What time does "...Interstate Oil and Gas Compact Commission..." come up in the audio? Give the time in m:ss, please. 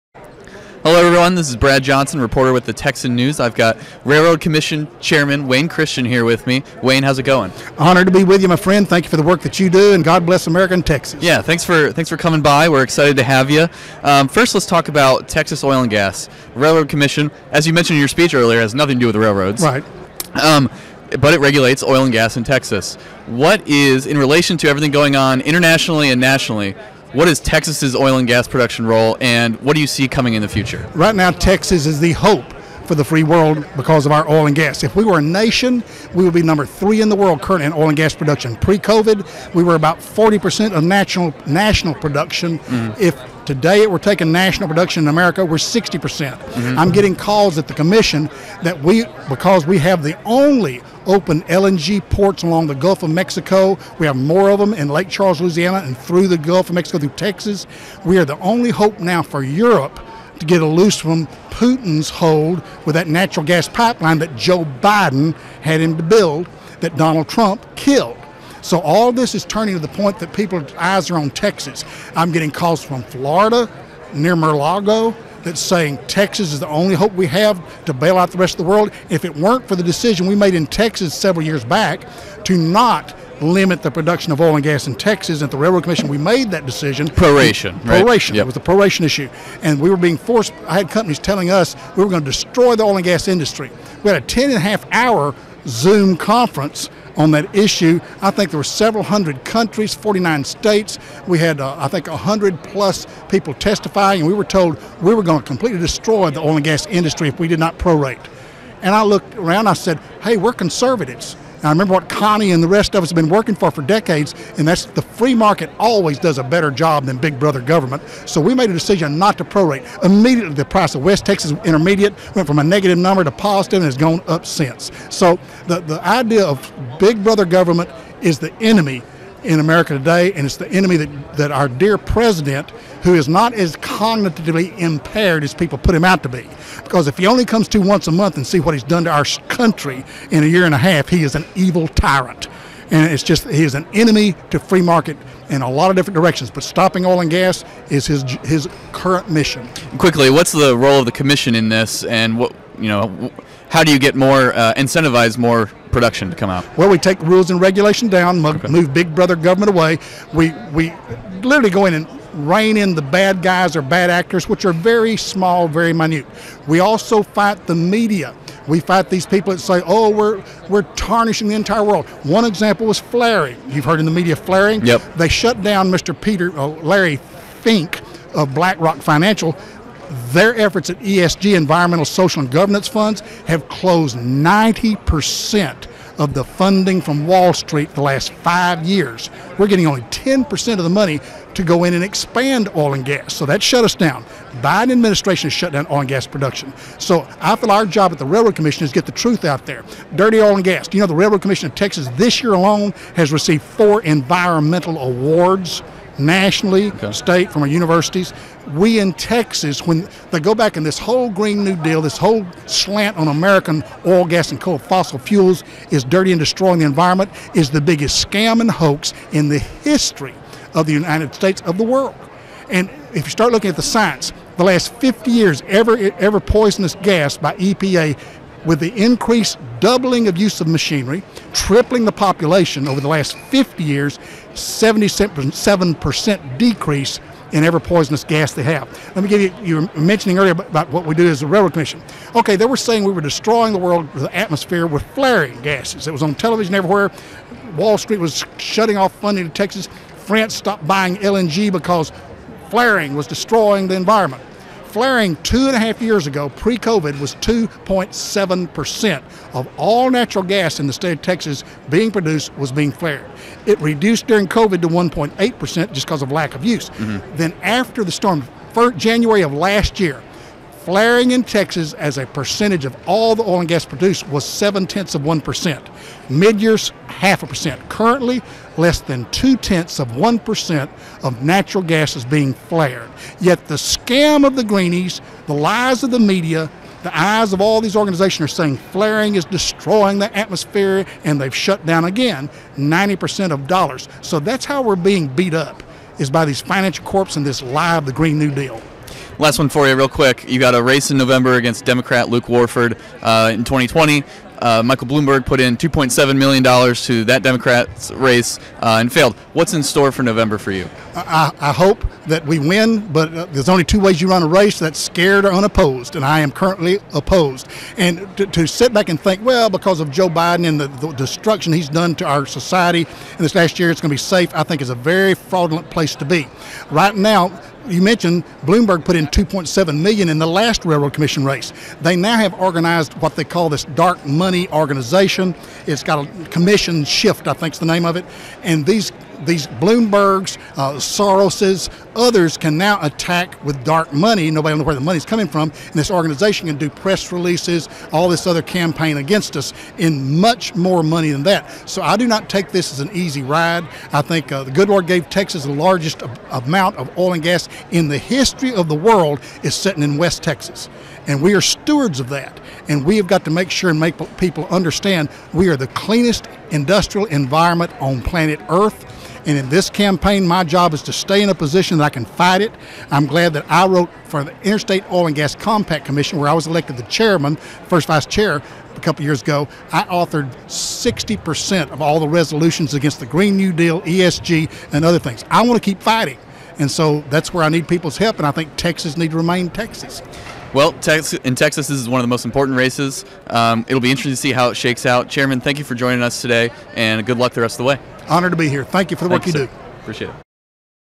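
6:14.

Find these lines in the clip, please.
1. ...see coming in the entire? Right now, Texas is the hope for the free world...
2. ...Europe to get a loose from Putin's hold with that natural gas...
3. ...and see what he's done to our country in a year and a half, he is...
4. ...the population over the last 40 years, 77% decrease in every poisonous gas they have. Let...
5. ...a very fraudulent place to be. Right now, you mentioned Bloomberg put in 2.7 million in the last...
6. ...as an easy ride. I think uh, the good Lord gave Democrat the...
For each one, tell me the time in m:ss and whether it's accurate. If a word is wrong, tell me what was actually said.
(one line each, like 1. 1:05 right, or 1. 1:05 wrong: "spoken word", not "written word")
1. 0:29 wrong: "future", not "entire"
2. 0:59 right
3. 2:18 right
4. 3:52 wrong: "50", not "40"
5. 5:24 right
6. 5:52 wrong: "Texas", not "Democrat".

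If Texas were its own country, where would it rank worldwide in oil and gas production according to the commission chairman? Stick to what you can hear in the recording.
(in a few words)
number 3.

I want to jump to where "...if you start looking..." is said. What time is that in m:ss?
3:43.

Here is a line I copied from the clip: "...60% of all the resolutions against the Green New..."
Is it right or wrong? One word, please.
right.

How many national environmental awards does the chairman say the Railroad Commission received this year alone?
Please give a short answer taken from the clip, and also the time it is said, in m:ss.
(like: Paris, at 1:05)
4, at 3:23.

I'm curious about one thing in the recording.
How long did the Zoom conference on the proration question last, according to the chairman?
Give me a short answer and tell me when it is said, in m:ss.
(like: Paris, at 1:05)
10.5 hours, at 1:34.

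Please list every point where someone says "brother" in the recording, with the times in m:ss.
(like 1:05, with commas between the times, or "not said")
1:57, 2:07, 2:39.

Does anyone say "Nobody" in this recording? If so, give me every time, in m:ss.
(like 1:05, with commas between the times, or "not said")
5:44.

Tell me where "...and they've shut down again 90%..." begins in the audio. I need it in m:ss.
4:51.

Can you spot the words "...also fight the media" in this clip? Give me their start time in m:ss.
2:46.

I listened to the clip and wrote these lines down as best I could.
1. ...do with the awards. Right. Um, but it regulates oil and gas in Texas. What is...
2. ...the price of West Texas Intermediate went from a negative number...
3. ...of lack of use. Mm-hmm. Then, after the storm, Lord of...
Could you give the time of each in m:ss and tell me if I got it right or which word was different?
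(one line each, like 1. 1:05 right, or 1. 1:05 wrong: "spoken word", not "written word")
1. 0:19 wrong: "railroads", not "awards"
2. 2:00 right
3. 4:26 wrong: "January", not "Lord".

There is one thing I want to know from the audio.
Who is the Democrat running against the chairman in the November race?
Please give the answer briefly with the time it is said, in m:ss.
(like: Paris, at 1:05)
Luke Warford, at 5:02.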